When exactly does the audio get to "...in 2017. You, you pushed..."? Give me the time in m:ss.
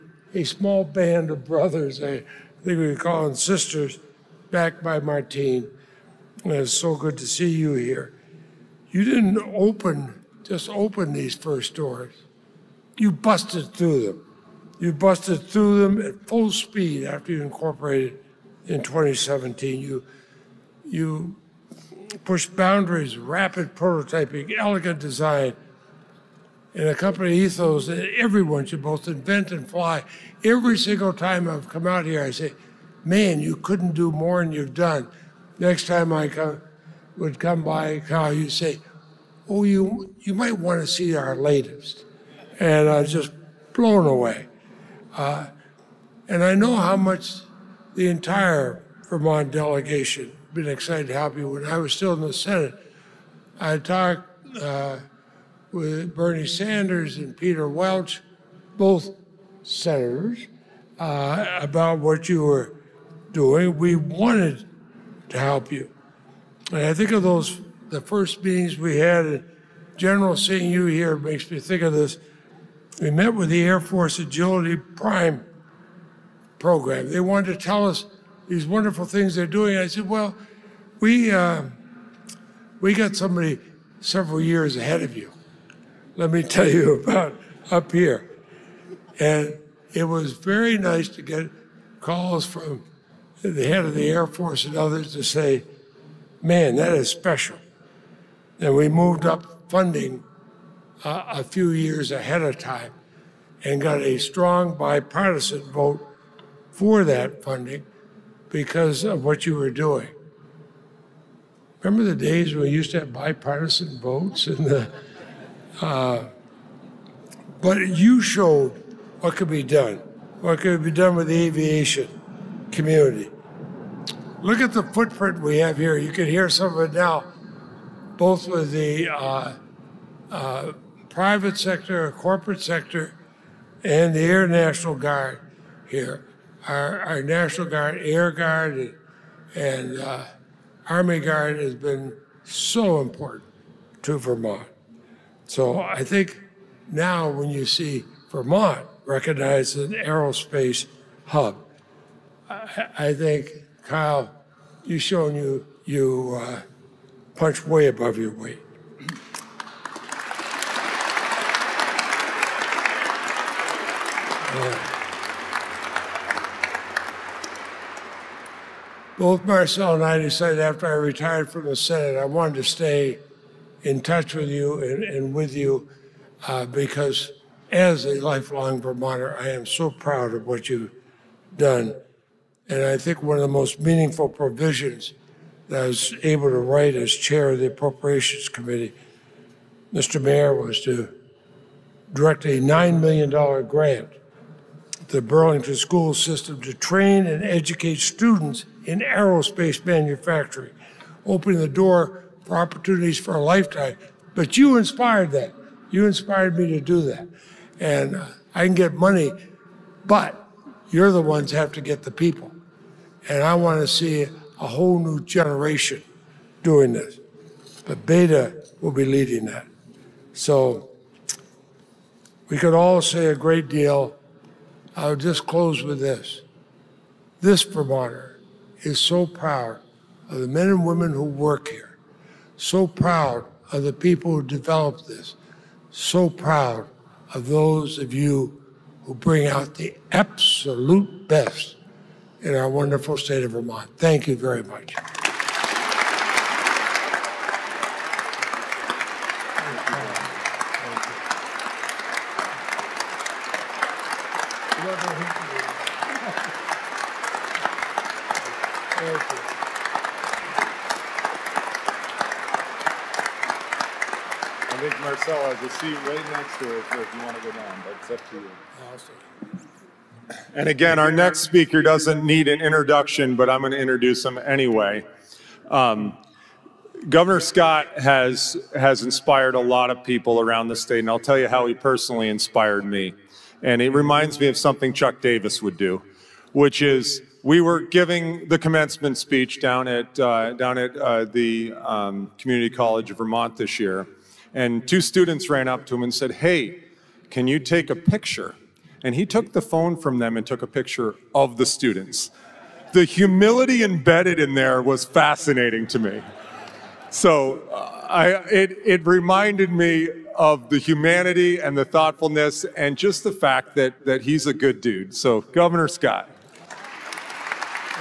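0:18.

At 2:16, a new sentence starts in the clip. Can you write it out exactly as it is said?
Our, our National Guard, Air Guard, and, uh, Army Guard has been so important to Vermont.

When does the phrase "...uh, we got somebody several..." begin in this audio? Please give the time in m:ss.
1:21.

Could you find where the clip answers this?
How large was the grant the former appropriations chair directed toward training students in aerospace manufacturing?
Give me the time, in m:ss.
3:12.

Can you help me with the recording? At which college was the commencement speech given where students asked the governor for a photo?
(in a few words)
Community College of Vermont.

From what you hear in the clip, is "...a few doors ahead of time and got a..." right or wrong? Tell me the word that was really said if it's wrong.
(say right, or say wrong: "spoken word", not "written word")
wrong: "years", not "doors".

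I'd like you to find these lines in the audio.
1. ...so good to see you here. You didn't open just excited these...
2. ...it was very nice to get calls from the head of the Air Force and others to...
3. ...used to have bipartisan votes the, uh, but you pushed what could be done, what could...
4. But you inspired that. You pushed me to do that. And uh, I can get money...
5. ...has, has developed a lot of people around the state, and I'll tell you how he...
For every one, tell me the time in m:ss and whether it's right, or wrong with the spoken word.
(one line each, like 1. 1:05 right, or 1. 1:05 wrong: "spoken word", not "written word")
1. 0:06 wrong: "opened", not "excited"
2. 1:29 right
3. 1:52 wrong: "showed", not "pushed"
4. 3:24 wrong: "inspired", not "pushed"
5. 4:37 wrong: "inspired", not "developed".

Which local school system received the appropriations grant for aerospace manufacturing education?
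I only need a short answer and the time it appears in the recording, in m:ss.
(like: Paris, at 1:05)
Burlington School System, at 3:15.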